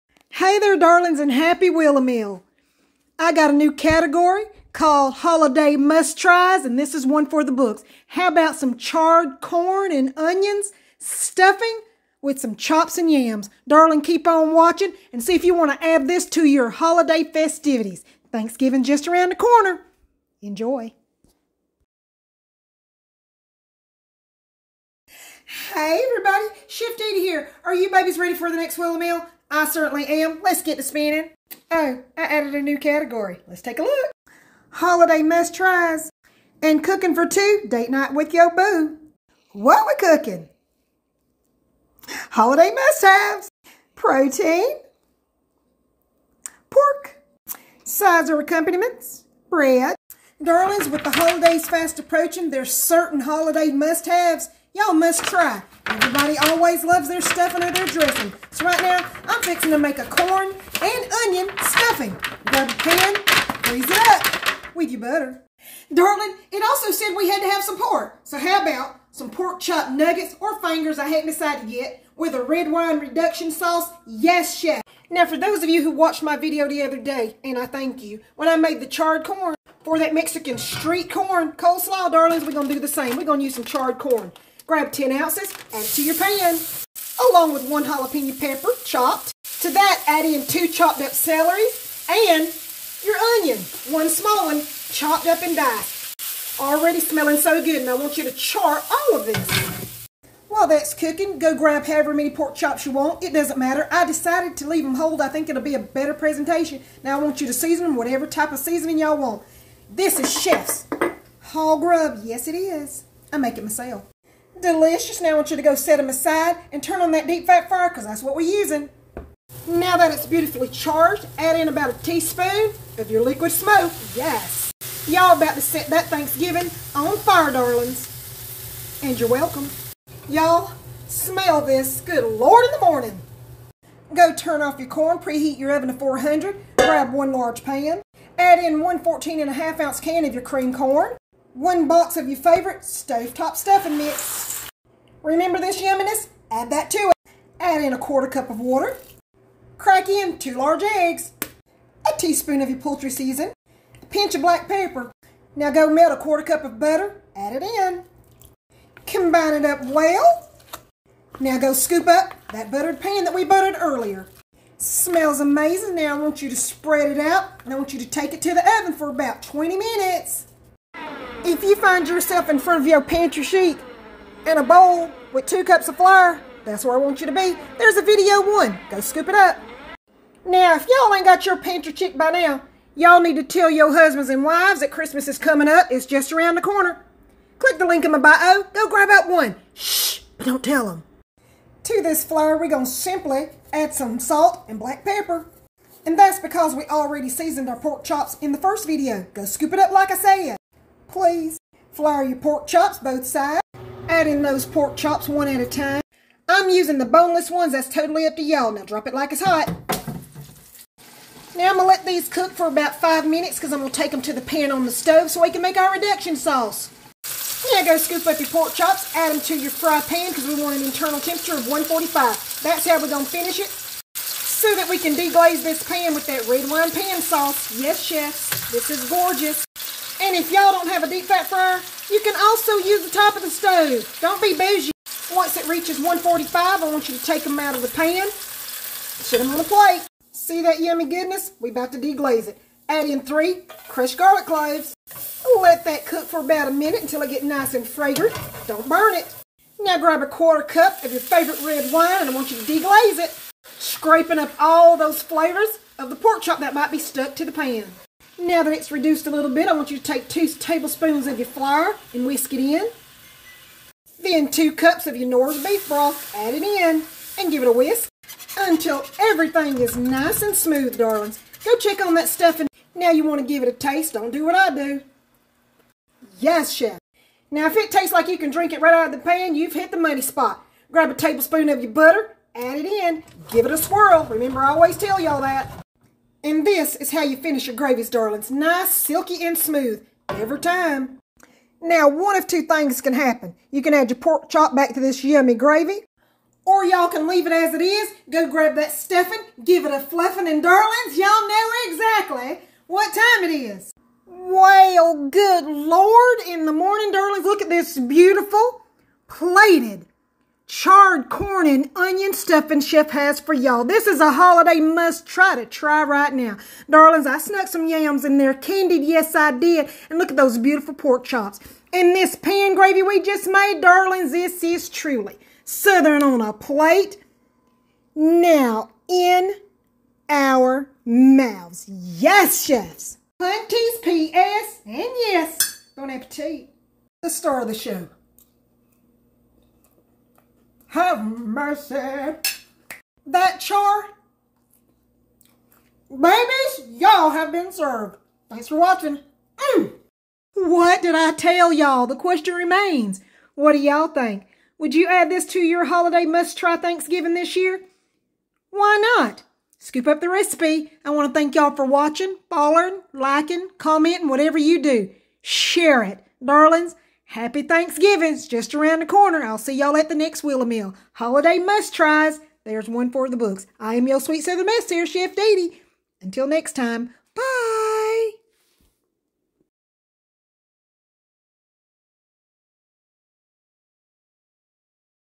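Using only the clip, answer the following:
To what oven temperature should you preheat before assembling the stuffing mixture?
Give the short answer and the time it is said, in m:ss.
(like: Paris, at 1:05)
400, at 2:15.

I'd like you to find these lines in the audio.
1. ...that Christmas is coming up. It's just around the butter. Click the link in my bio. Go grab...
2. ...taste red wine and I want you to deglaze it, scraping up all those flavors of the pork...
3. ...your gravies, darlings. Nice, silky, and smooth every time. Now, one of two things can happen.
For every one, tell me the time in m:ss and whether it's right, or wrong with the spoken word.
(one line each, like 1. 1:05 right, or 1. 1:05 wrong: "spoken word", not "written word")
1. 3:04 wrong: "corner", not "butter"
2. 4:11 wrong: "favorite", not "taste"
3. 4:47 right.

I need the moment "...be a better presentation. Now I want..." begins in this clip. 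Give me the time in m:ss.
1:45.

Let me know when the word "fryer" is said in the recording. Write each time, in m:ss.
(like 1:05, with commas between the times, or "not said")
1:57, 3:51.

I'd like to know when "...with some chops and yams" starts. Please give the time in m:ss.
0:12.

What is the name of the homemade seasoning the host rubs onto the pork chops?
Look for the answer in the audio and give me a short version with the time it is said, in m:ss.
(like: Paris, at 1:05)
Hog grub, at 1:51.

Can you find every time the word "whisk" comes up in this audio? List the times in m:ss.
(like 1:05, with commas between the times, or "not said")
4:22, 4:27.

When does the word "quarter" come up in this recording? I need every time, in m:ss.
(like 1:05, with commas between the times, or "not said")
2:27, 2:36, 4:10.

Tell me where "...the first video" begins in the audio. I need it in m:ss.
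3:18.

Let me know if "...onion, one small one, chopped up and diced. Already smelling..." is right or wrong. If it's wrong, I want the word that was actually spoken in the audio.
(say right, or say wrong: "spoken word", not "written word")
right.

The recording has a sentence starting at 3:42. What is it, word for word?
That's how we're going to finish it so that we can deglaze this pan with that red wine pan sauce.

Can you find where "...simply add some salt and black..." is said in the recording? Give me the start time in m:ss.
3:12.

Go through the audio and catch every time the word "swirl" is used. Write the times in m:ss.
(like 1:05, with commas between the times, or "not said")
4:43.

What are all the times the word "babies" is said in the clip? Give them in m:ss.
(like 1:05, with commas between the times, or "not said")
0:27, 5:46.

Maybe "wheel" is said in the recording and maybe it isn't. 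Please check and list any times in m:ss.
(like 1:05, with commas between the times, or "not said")
0:01, 0:28, 6:10.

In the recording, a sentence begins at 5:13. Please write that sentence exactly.
This is a holiday must try to try right now.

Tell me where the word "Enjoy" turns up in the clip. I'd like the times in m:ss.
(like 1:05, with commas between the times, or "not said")
0:20.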